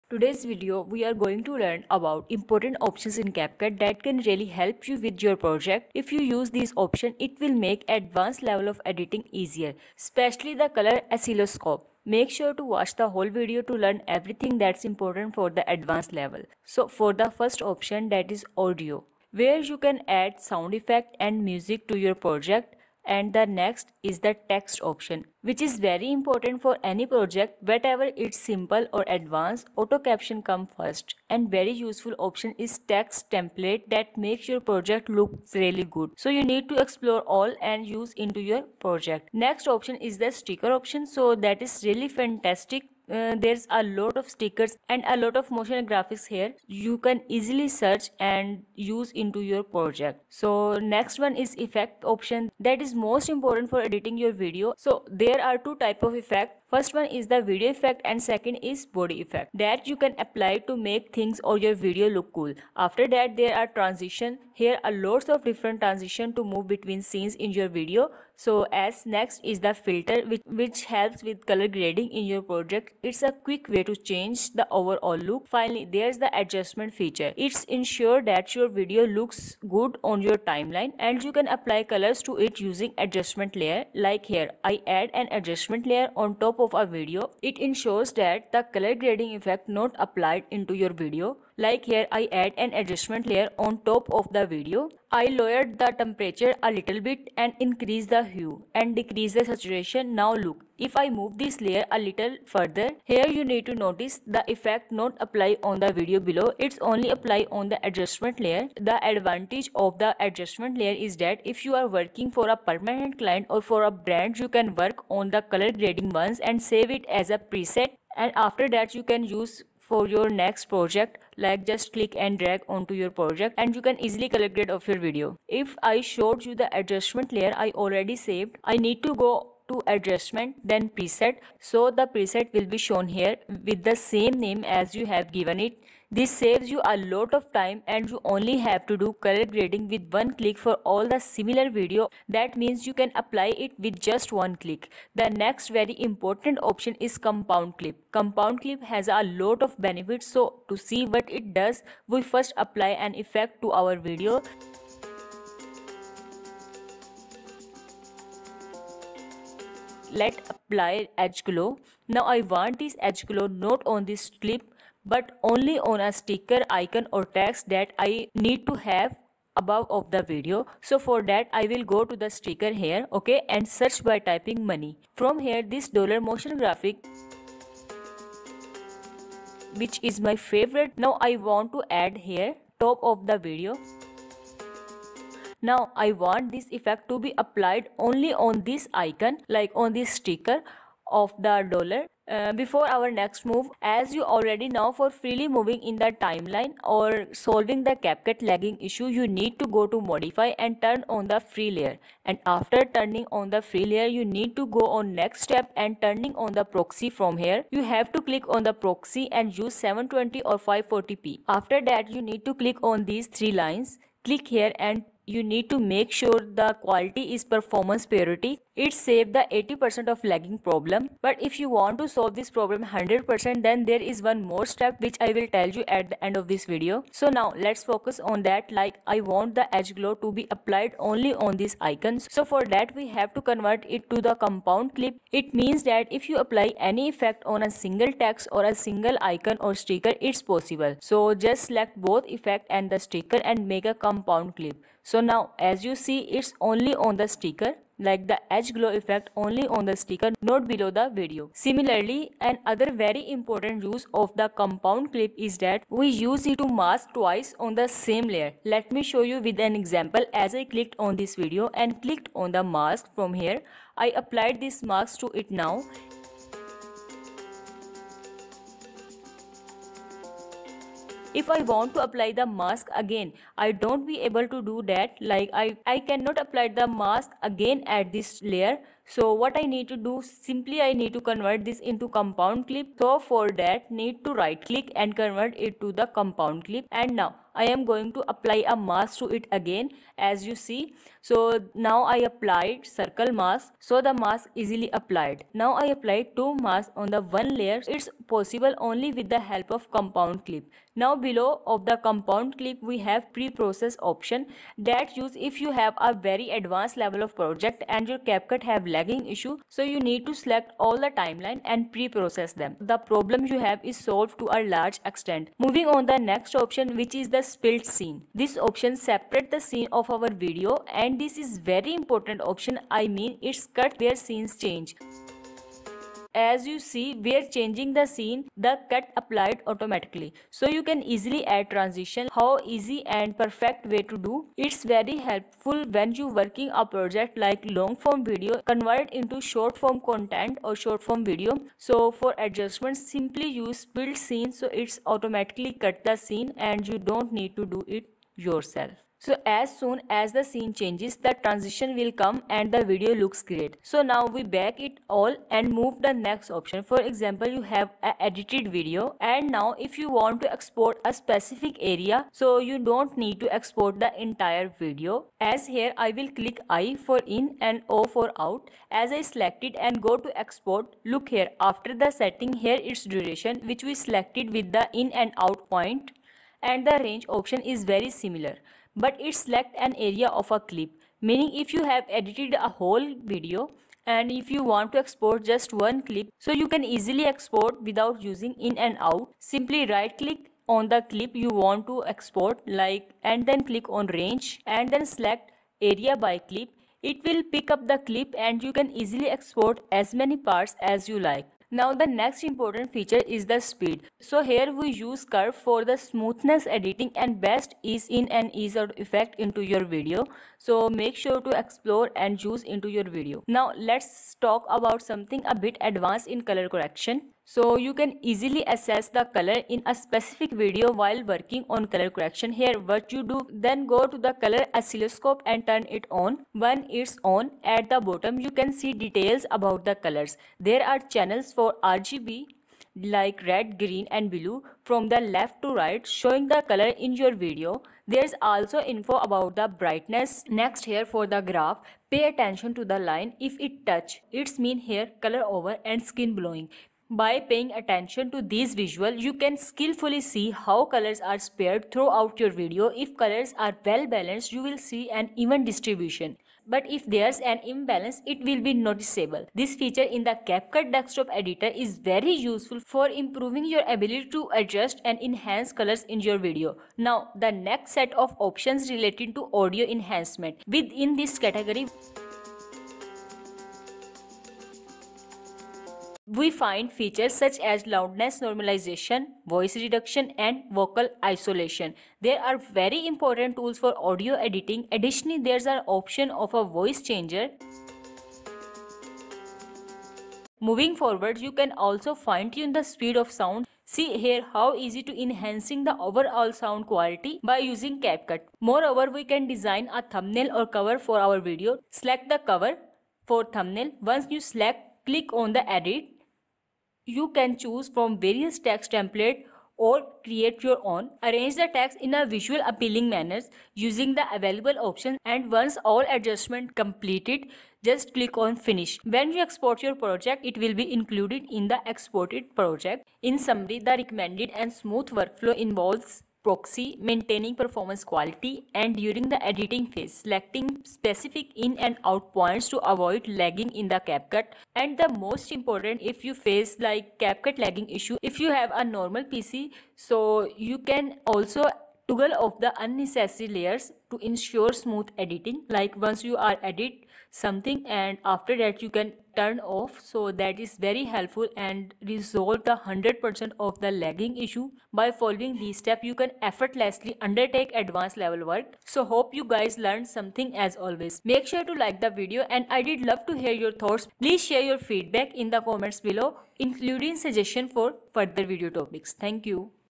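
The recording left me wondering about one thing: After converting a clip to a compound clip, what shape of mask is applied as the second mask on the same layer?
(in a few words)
circle.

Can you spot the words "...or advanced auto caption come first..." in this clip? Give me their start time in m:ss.
0:28.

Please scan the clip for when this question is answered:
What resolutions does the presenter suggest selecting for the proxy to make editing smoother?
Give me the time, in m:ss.
3:29.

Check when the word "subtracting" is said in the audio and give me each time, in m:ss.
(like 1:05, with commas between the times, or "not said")
not said.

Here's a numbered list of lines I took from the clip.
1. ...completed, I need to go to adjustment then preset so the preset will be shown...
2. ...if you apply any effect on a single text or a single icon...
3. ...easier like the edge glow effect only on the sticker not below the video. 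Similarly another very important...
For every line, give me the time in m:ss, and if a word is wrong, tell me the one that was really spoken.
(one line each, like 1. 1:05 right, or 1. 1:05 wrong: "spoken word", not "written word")
1. 2:08 wrong: "saved", not "completed"
2. 3:56 right
3. 4:07 wrong: "sticker", not "easier".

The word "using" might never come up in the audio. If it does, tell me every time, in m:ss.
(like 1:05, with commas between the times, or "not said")
1:22, 6:28, 8:17, 8:33.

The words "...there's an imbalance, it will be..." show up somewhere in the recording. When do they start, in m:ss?
7:37.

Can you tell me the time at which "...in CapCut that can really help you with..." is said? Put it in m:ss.
0:03.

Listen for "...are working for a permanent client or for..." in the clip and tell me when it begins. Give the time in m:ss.
1:51.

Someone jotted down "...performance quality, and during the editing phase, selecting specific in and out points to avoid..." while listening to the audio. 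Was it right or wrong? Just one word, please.
right.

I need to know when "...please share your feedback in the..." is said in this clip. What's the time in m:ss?
9:24.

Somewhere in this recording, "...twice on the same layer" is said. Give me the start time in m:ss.
4:17.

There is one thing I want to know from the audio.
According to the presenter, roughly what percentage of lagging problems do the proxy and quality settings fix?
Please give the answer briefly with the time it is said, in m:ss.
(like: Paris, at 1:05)
80%, at 3:39.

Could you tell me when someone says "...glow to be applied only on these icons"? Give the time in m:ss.
3:49.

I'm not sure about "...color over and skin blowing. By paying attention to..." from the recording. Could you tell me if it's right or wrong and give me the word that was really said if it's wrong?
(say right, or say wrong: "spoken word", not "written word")
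right.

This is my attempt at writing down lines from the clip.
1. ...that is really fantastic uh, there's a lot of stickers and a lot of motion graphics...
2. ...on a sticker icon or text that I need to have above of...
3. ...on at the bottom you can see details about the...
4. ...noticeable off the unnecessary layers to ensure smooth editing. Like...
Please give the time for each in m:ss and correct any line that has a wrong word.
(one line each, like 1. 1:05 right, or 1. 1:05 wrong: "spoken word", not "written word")
1. 0:41 right
2. 2:45 right
3. 7:07 right
4. 9:02 wrong: "toggle", not "noticeable".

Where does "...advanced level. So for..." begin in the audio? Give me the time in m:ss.
0:15.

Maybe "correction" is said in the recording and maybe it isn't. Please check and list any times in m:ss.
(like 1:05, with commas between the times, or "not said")
6:56, 7:02.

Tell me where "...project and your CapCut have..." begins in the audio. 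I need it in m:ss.
5:07.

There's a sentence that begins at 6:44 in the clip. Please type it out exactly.
So here we use curve for the smoothness editing and best ease in and ease out effect into your video.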